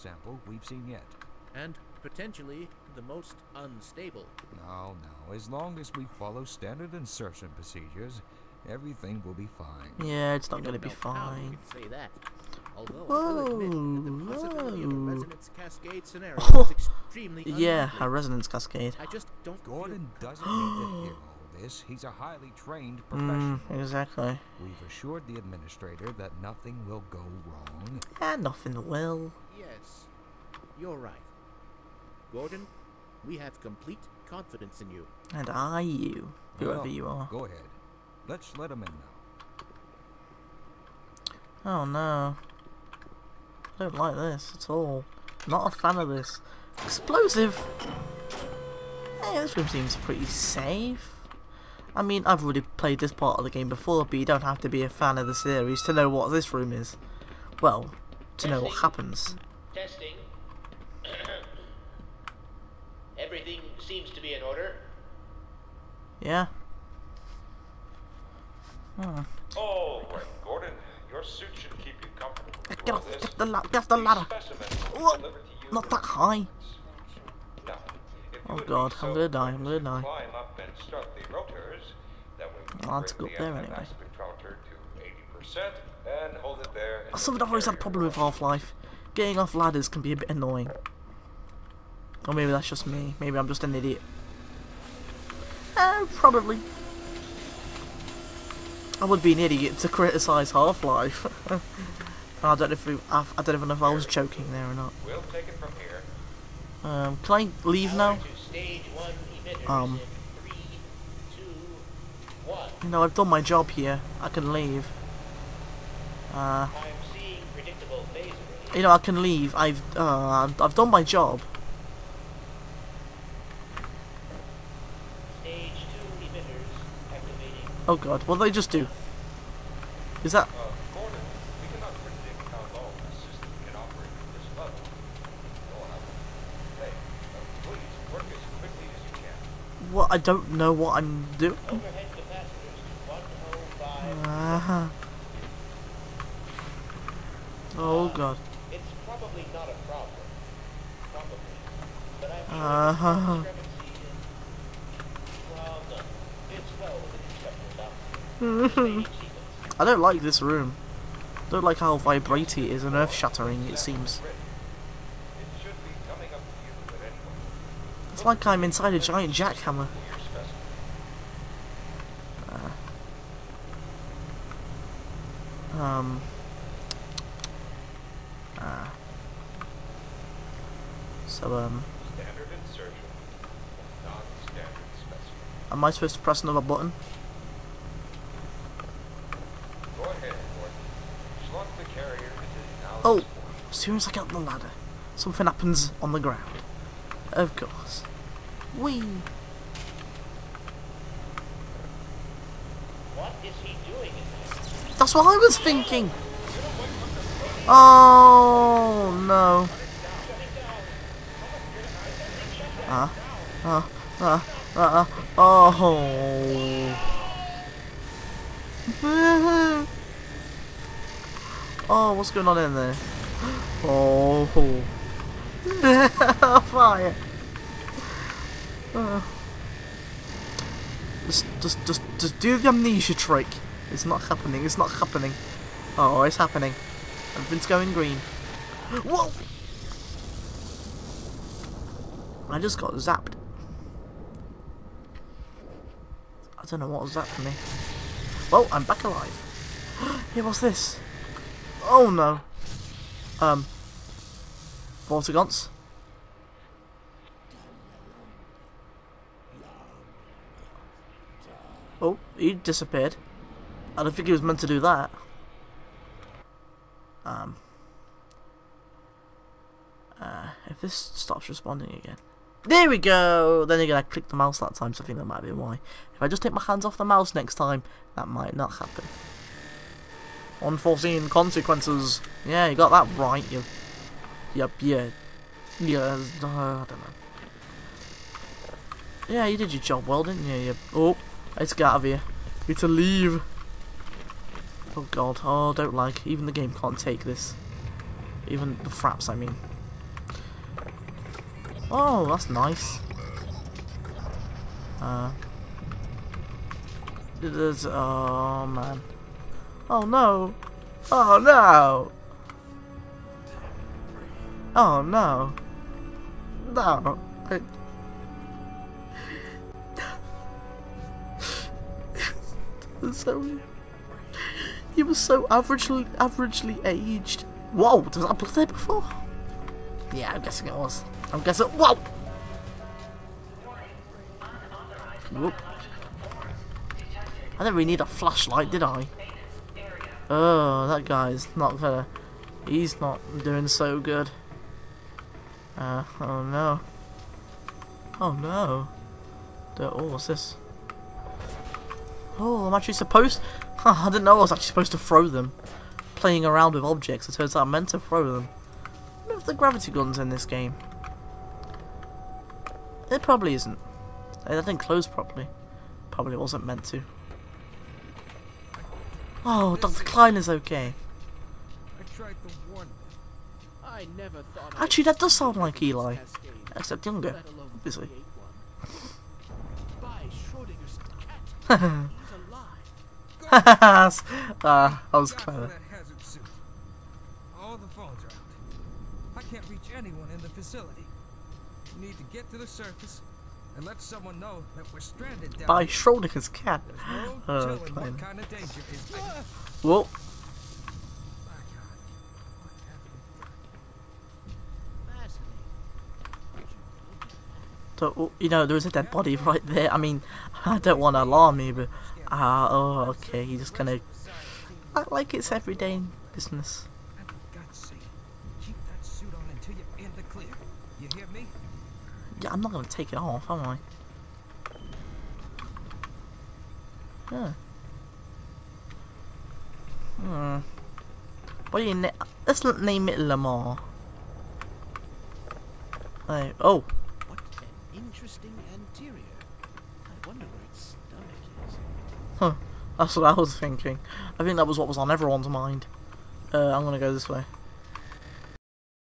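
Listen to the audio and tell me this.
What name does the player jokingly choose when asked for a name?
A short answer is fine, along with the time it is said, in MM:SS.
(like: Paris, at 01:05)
Lamar, at 07:13.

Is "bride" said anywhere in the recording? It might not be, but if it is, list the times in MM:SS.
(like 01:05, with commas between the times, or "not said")
not said.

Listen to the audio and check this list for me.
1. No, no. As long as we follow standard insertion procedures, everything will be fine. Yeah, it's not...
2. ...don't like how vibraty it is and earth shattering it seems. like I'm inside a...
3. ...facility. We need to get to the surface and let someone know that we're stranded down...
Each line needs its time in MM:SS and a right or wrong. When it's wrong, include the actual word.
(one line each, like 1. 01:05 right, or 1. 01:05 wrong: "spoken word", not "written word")
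1. 00:04 right
2. 02:41 right
3. 06:30 right.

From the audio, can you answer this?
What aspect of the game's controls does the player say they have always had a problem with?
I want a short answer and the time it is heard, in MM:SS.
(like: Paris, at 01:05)
Getting off ladders, at 01:29.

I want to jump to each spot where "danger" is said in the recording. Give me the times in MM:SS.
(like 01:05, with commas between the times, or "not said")
06:38.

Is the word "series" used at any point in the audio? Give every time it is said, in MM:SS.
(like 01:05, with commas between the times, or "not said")
00:55.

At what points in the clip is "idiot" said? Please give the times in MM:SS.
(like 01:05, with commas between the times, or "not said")
01:33, 01:39.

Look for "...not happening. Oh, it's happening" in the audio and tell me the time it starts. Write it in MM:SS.
03:54.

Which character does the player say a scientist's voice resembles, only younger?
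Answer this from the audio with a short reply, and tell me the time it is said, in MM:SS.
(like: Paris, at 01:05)
Eli, at 06:15.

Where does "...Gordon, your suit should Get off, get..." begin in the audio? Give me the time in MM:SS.
01:10.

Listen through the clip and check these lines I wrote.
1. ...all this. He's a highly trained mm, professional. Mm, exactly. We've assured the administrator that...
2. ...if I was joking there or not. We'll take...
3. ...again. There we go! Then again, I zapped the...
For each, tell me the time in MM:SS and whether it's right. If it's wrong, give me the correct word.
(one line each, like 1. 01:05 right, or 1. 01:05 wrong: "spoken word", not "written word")
1. 00:21 right
2. 01:43 right
3. 04:31 wrong: "clicked", not "zapped".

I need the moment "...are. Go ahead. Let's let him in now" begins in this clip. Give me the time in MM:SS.
00:37.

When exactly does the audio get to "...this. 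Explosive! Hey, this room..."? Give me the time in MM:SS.
00:46.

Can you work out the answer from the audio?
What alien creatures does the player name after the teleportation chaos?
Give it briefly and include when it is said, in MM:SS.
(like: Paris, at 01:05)
Vortigaunts, at 04:15.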